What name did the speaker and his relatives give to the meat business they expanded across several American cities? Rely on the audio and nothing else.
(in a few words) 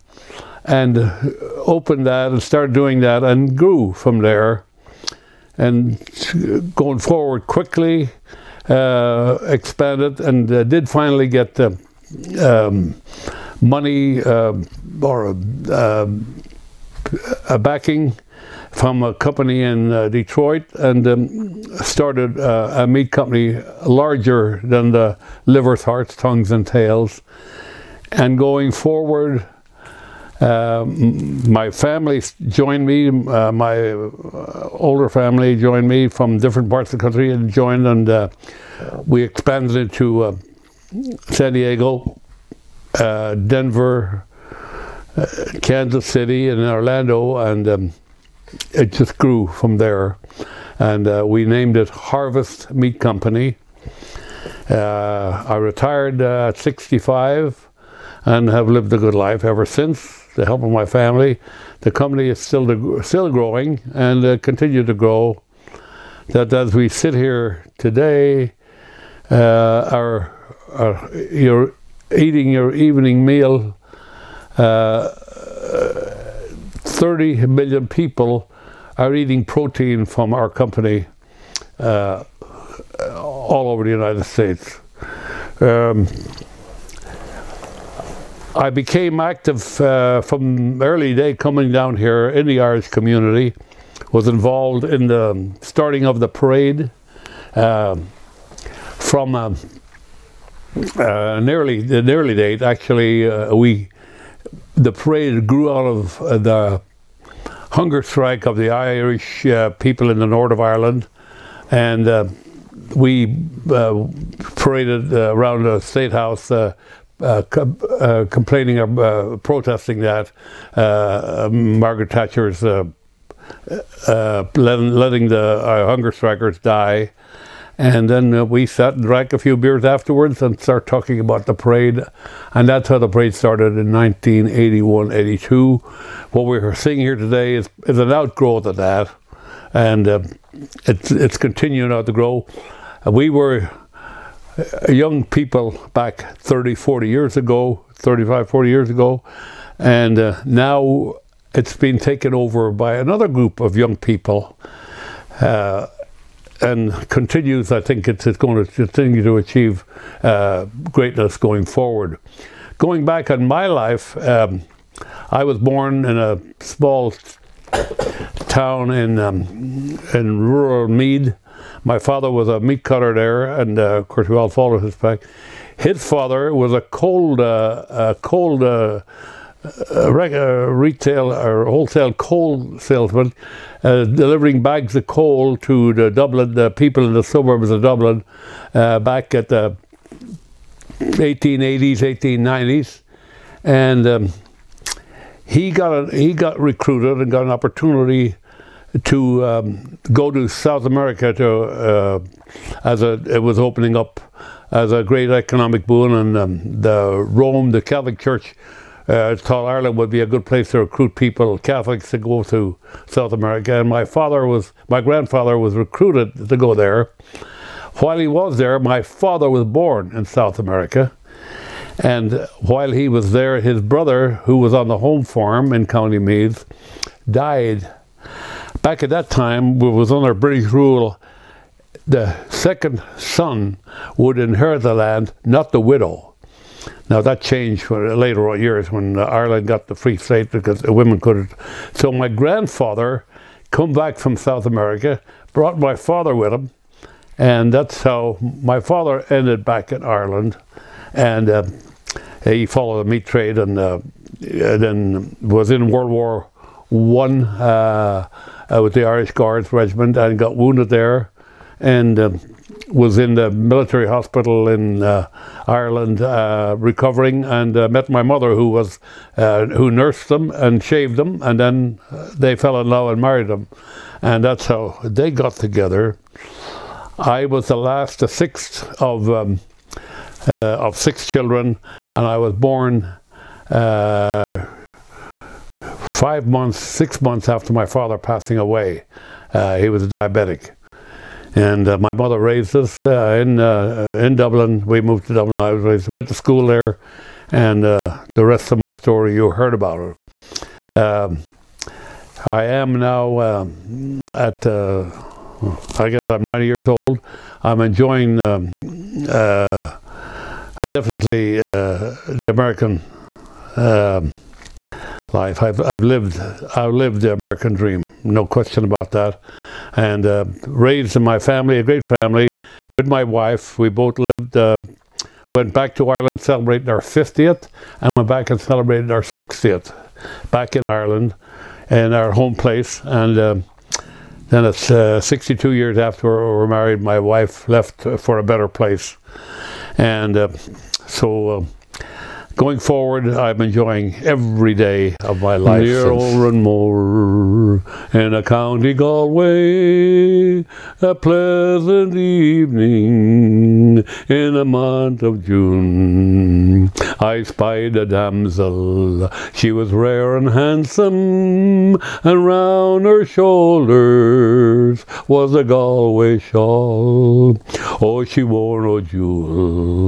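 Harvest Meat Company.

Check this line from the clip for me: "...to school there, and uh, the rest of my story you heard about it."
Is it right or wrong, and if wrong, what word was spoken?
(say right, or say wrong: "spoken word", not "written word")
right.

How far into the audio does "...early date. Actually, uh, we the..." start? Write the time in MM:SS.
01:41.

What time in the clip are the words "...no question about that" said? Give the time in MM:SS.
05:18.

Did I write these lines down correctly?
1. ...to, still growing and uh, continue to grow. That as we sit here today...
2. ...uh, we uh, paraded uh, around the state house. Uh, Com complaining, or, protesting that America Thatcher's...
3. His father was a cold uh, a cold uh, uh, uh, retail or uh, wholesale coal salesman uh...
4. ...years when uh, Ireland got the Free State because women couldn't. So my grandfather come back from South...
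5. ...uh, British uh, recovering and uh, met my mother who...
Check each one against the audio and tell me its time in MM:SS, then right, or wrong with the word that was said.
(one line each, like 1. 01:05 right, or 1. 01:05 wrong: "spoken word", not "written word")
1. 01:02 right
2. 01:52 wrong: "Margaret", not "America"
3. 02:55 right
4. 03:58 right
5. 04:25 wrong: "Ireland", not "British".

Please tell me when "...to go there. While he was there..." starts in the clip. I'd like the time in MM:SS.
03:36.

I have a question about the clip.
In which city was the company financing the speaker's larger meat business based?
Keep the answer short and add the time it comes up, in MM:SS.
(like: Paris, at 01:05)
Detroit, at 00:20.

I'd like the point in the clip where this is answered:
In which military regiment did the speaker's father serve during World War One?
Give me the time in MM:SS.
04:19.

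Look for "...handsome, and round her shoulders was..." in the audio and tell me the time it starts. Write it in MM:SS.
06:00.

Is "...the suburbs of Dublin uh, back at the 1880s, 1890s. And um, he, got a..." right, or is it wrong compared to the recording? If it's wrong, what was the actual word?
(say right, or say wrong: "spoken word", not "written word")
right.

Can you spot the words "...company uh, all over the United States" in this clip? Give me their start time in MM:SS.
01:20.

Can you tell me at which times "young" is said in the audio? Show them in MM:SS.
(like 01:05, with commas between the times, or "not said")
02:24, 02:33.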